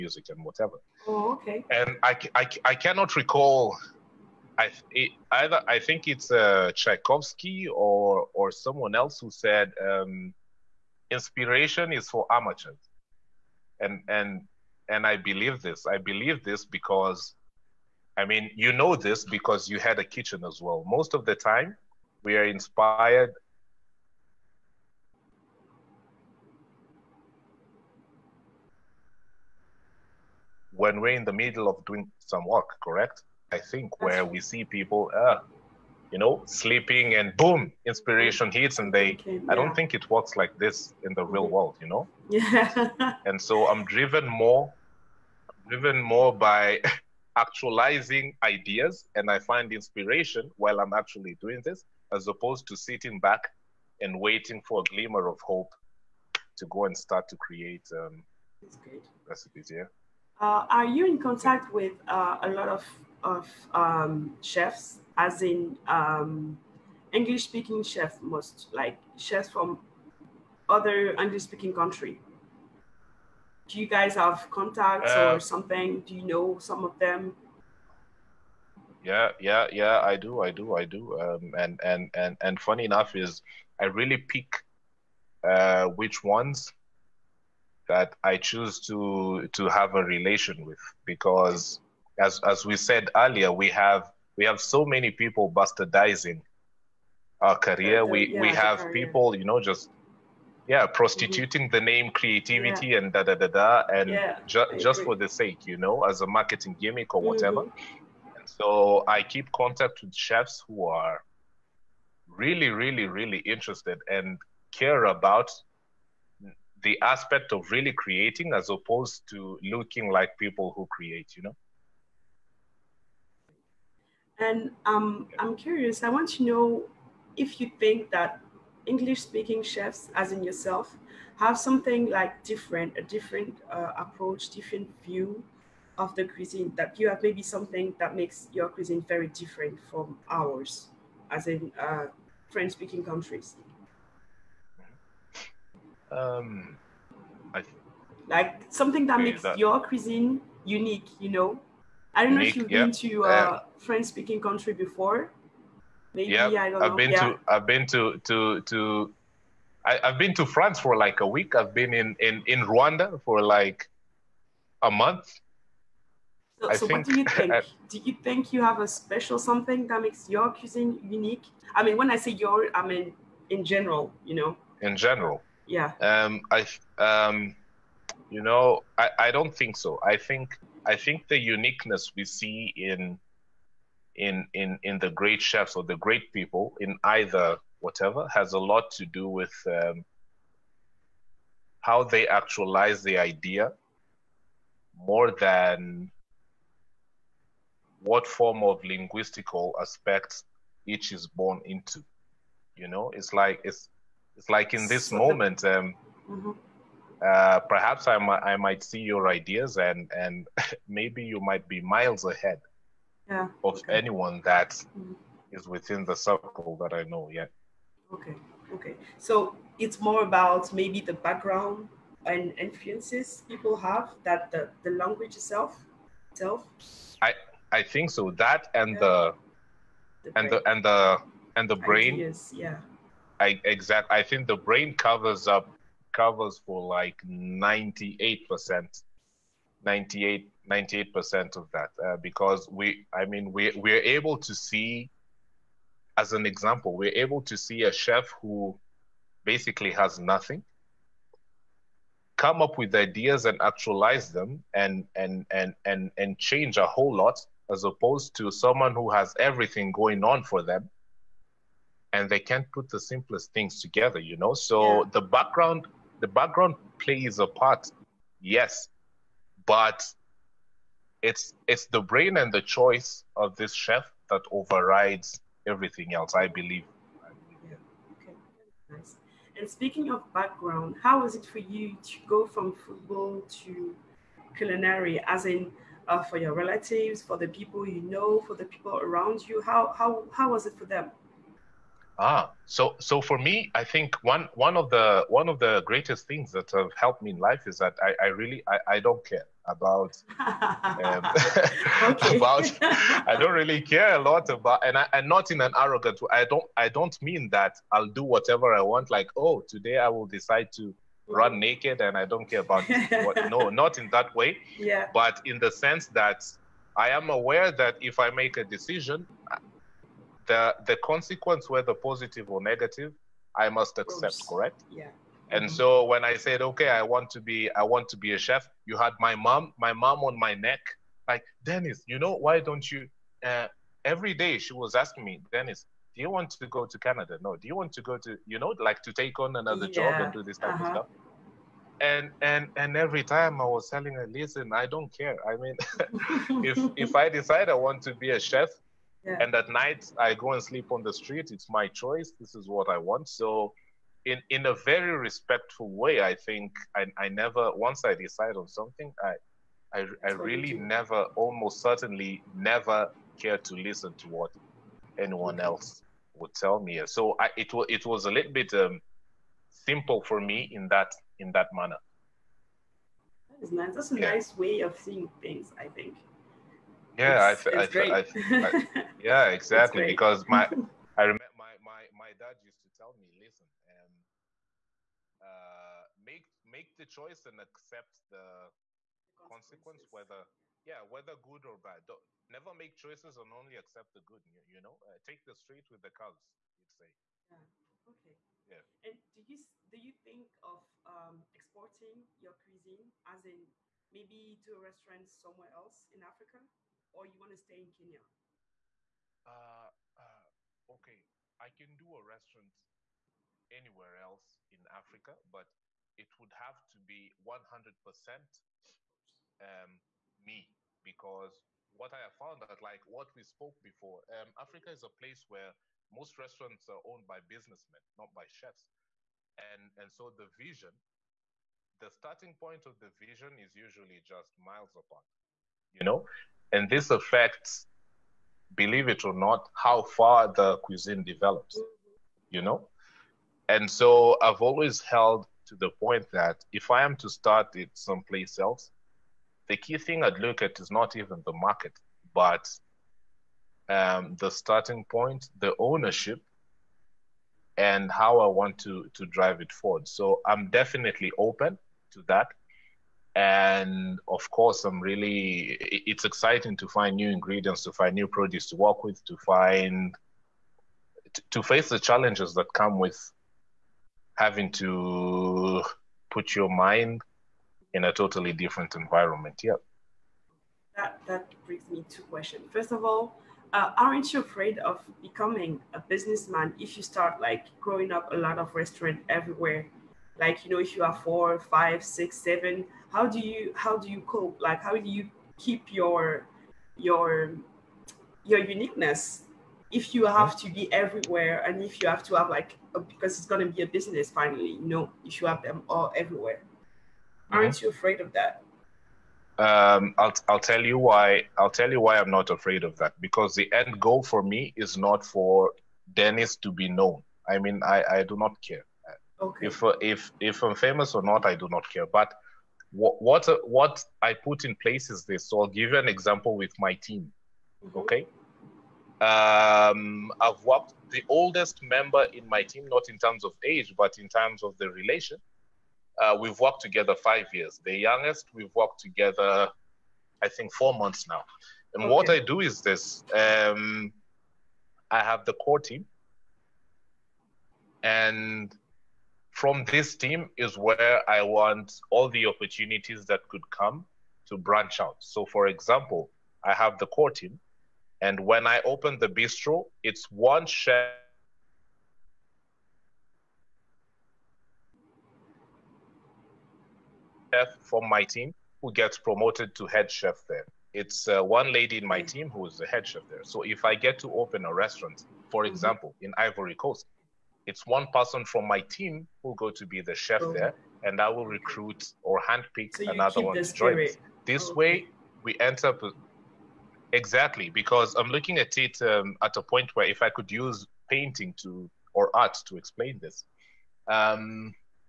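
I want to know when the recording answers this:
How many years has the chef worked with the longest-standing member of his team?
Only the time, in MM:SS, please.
08:57.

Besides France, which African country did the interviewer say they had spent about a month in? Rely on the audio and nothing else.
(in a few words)
Rwanda.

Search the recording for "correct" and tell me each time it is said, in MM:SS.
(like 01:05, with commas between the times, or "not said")
00:32, 05:24.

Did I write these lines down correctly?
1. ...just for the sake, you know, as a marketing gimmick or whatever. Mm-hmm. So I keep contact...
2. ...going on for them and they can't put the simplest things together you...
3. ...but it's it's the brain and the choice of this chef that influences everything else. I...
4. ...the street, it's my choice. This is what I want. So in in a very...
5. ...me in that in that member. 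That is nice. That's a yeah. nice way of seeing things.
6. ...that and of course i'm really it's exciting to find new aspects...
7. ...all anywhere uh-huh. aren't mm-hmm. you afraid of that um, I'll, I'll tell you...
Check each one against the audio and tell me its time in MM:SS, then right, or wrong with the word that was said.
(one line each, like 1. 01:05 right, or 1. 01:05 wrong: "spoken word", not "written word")
1. 01:44 right
2. 04:19 right
3. 04:29 wrong: "overrides", not "influences"
4. 05:51 right
5. 06:10 wrong: "manner", not "member"
6. 07:42 wrong: "ingredients", not "aspects"
7. 08:25 wrong: "everywhere", not "anywhere".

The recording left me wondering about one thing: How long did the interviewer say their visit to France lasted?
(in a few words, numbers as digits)
A week.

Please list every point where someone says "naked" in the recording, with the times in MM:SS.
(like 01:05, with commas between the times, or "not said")
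05:11.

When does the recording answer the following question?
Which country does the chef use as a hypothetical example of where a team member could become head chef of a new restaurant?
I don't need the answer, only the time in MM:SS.
09:36.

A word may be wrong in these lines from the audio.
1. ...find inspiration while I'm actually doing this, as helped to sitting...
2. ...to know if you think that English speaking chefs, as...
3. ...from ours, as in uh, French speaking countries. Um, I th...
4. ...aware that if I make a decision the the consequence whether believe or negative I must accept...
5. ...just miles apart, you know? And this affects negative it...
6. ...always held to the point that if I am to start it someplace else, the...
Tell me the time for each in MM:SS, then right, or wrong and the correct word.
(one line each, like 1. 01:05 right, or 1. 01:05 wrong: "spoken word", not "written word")
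1. 00:49 wrong: "opposed", not "helped"
2. 02:06 right
3. 02:19 right
4. 05:17 wrong: "positive", not "believe"
5. 07:14 wrong: "believe", not "negative"
6. 07:24 right.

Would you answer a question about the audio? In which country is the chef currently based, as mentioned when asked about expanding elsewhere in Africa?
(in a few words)
Kenya.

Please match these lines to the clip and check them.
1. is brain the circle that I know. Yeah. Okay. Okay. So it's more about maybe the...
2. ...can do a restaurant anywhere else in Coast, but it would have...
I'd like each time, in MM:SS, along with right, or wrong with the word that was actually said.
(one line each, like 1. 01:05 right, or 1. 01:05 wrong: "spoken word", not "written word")
1. 03:35 wrong: "within", not "brain"
2. 06:51 wrong: "Africa", not "Coast".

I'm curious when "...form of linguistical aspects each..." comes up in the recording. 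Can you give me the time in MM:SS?
03:18.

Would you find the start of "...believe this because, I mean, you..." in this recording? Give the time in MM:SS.
00:15.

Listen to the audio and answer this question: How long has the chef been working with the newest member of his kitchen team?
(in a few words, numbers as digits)
4 months.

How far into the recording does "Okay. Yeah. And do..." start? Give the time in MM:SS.
06:38.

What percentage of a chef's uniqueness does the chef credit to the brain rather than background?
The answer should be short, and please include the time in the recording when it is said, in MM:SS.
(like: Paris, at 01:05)
98%, at 03:57.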